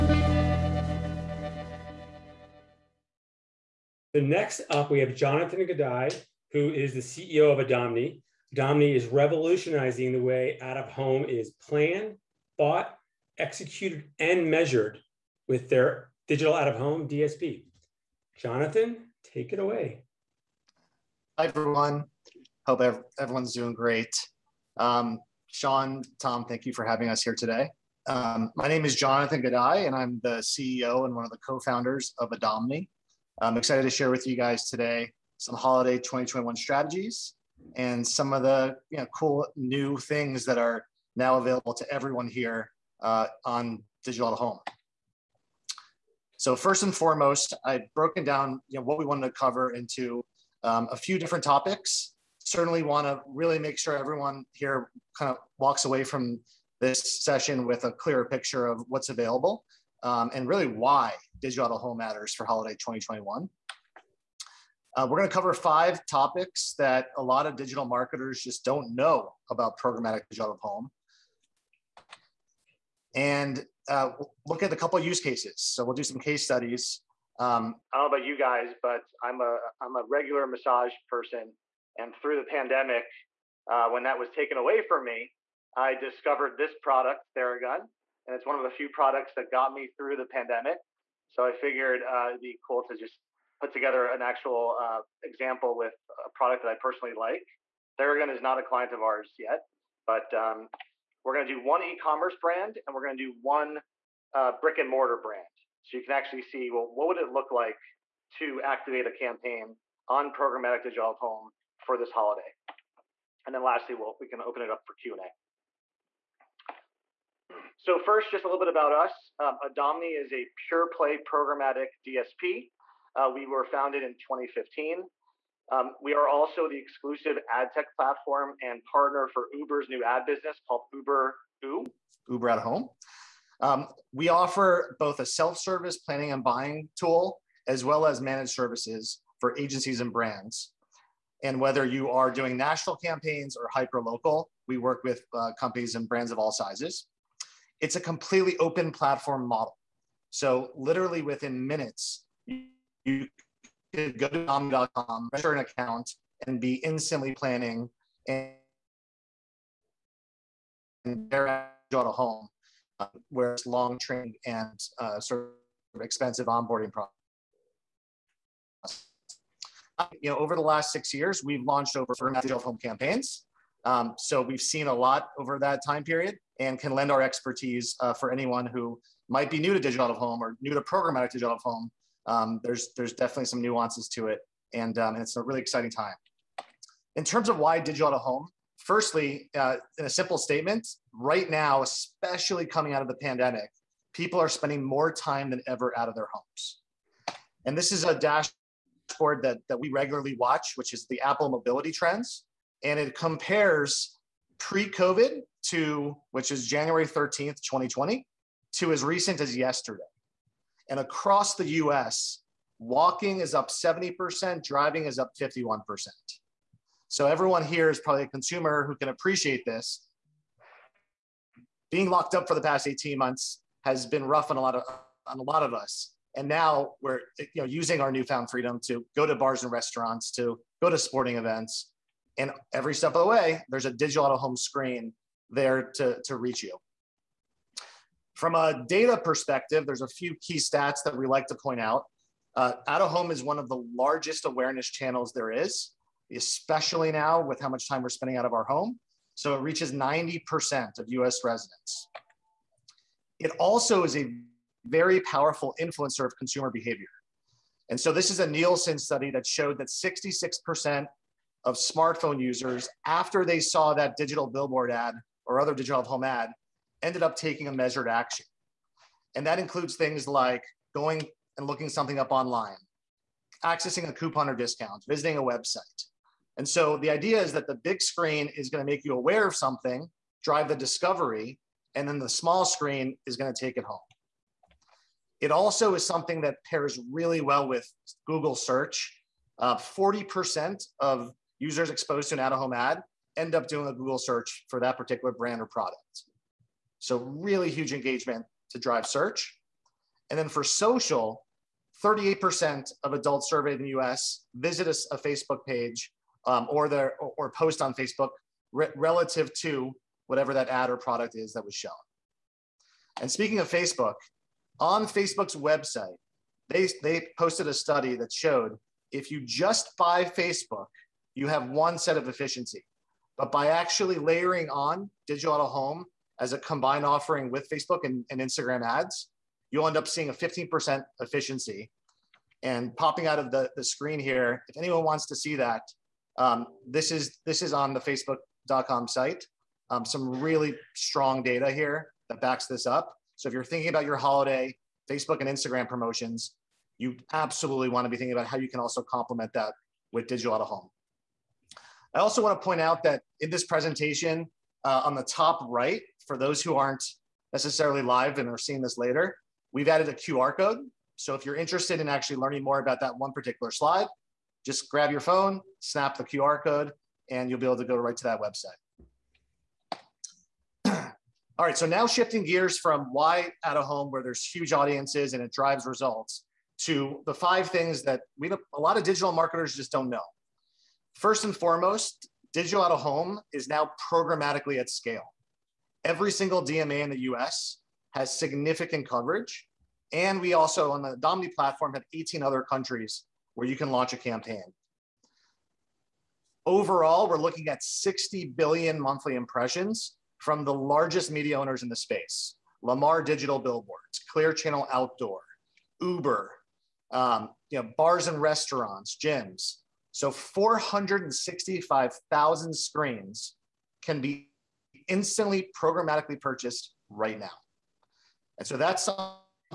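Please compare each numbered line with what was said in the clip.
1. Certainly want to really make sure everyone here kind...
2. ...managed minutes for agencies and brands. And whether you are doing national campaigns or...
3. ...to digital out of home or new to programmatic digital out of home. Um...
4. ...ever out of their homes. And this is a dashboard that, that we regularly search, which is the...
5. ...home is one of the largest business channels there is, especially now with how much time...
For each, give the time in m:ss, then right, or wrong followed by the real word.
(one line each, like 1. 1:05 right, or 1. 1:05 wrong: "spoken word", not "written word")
1. 0:52 right
2. 2:18 wrong: "services", not "minutes"
3. 2:59 right
4. 3:15 wrong: "watch", not "search"
5. 4:03 wrong: "awareness", not "business".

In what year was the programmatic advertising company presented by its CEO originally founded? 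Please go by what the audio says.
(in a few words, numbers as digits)
2015.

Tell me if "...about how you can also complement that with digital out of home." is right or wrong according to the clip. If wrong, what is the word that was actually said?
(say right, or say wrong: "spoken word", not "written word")
right.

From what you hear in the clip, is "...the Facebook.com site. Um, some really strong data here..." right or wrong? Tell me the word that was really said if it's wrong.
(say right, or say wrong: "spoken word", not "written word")
right.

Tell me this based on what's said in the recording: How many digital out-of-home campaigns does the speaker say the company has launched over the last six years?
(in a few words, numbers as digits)
400.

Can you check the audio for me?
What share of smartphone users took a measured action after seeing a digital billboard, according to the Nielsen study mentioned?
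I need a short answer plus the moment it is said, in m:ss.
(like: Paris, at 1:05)
66%, at 4:19.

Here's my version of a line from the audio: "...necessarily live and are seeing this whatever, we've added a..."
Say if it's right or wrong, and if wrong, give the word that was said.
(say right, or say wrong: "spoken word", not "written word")
wrong: "later", not "whatever".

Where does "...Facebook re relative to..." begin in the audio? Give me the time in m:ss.
5:07.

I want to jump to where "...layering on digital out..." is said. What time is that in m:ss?
5:24.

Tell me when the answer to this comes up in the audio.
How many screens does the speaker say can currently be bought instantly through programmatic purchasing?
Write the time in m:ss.
6:50.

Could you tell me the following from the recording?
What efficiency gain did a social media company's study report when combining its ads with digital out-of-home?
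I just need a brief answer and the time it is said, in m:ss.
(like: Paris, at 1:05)
15%, at 5:30.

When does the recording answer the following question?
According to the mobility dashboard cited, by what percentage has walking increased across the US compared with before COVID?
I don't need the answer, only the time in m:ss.
3:33.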